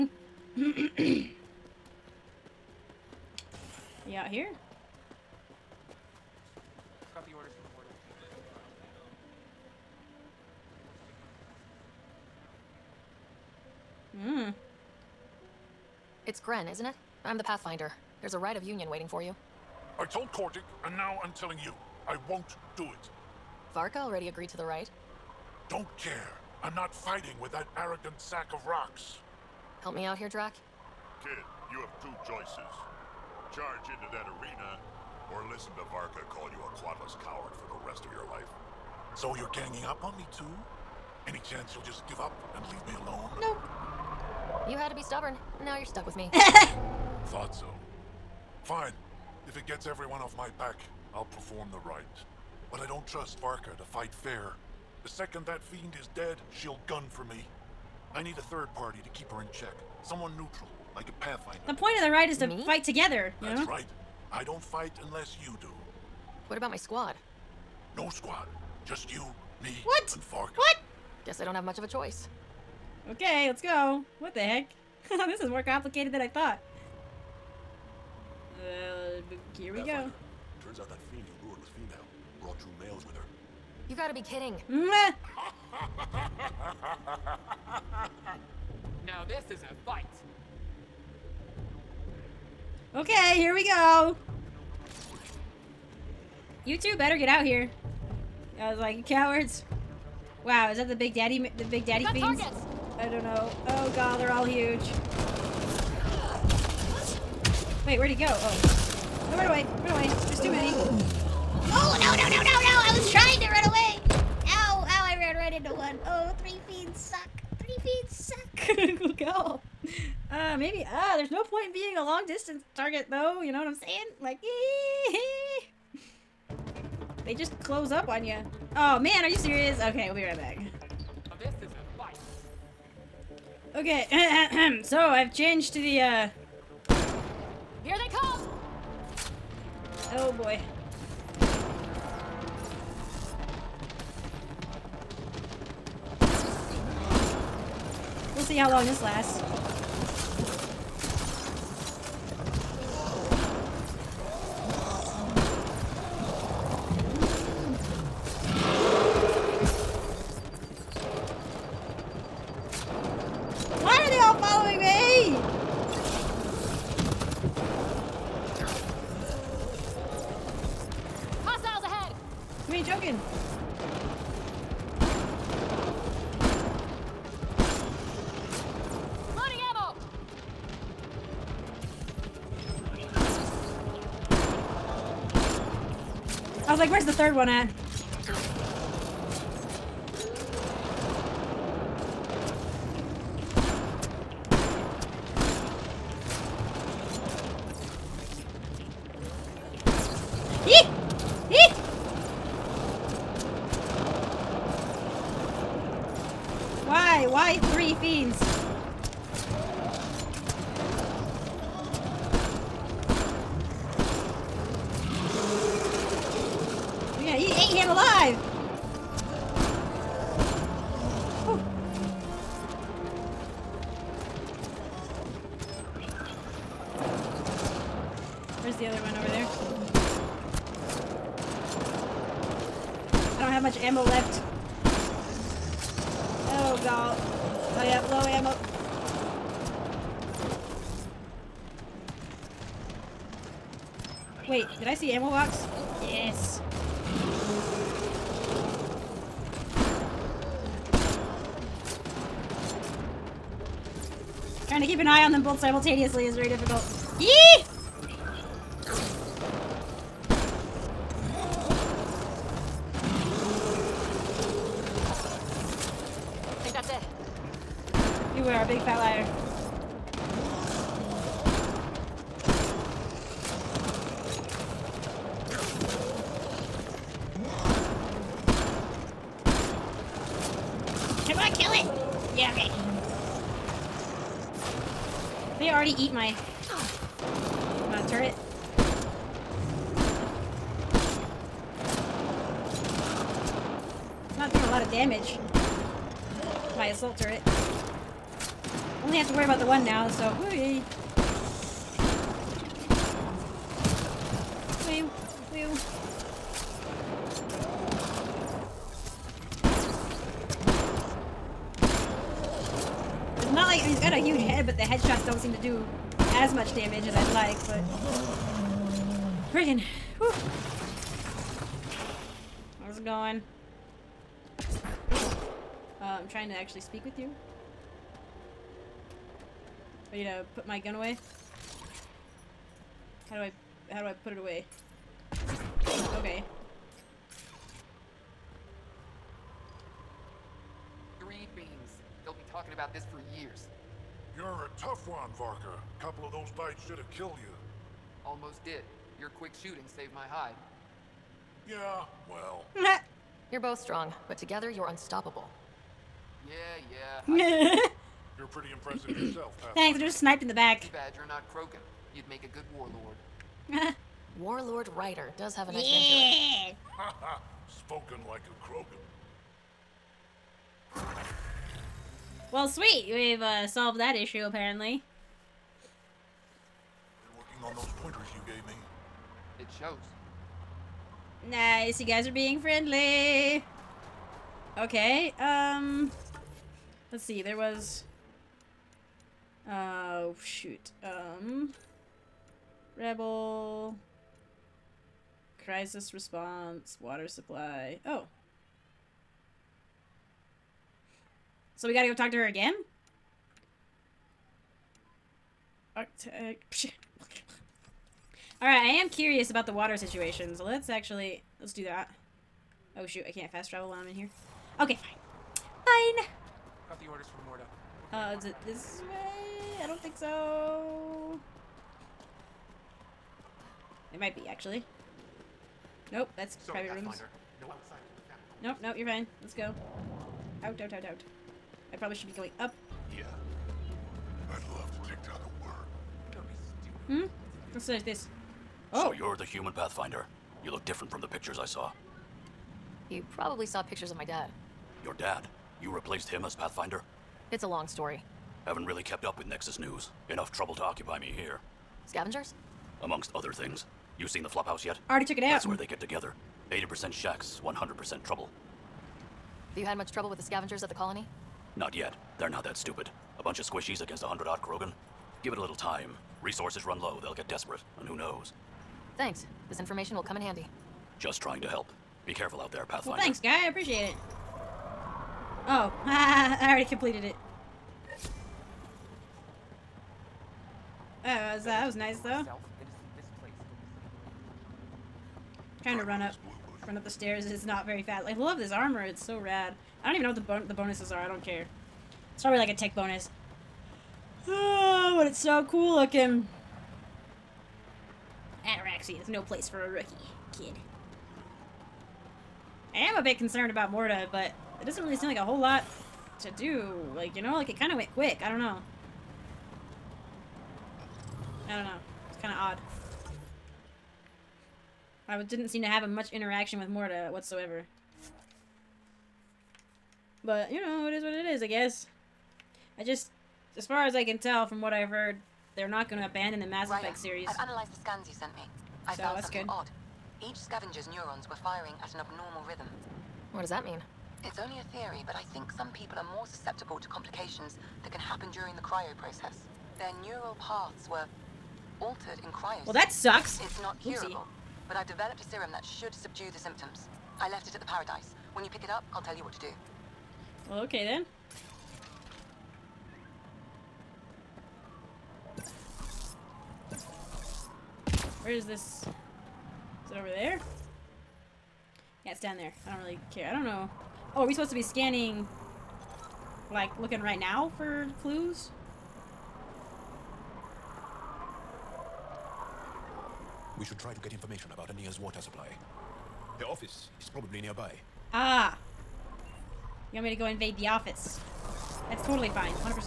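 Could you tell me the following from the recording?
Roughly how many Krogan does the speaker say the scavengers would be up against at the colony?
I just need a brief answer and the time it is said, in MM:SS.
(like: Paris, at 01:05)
100, at 07:44.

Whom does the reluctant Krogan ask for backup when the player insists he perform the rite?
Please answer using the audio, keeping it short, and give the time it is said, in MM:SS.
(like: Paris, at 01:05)
Drack, at 00:30.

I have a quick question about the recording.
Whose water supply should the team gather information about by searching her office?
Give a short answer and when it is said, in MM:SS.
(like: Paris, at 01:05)
Ania, at 09:34.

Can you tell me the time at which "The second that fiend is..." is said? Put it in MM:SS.
00:55.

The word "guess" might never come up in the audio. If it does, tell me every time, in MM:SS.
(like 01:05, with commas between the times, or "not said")
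01:11, 08:41.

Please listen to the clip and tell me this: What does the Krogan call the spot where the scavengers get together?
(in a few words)
the flophouse.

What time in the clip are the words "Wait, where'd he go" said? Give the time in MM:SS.
01:47.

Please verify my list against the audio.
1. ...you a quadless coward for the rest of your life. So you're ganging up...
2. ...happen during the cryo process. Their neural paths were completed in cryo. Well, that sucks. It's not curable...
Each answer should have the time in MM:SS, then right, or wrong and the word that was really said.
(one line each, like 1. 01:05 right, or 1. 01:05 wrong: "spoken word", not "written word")
1. 00:36 right
2. 08:58 wrong: "altered", not "completed".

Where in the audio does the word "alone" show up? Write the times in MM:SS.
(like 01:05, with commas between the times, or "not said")
00:43.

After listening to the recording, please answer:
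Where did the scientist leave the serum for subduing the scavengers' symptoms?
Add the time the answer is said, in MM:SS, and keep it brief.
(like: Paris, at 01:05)
the paradise, at 09:07.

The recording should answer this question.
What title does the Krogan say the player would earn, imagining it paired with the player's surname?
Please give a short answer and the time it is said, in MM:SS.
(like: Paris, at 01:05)
Warlord Ryder, at 06:04.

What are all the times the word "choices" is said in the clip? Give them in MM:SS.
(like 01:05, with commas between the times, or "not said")
00:32, 01:11.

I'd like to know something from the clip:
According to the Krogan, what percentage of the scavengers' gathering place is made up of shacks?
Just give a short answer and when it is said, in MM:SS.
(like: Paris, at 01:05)
80%, at 07:36.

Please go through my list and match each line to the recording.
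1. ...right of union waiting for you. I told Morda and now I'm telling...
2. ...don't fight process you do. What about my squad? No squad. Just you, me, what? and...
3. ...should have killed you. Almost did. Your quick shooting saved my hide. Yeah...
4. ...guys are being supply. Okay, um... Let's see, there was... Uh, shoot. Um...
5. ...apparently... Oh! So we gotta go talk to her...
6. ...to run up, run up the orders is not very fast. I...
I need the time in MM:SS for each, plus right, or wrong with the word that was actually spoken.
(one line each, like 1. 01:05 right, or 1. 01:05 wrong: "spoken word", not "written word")
1. 00:18 wrong: "Kordic", not "Morda"
2. 01:04 wrong: "unless", not "process"
3. 05:46 right
4. 06:22 wrong: "friendly", not "supply"
5. 06:37 wrong: "supply", not "apparently"
6. 08:05 wrong: "stairs", not "orders".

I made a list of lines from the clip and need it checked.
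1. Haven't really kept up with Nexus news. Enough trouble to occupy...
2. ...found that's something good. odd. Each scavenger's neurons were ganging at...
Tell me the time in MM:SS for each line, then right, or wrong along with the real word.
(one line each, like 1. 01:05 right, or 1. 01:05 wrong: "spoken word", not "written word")
1. 07:28 right
2. 08:49 wrong: "firing", not "ganging".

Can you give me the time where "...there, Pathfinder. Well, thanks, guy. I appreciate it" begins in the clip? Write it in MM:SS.
07:52.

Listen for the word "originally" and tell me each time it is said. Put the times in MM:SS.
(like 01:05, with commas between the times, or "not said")
not said.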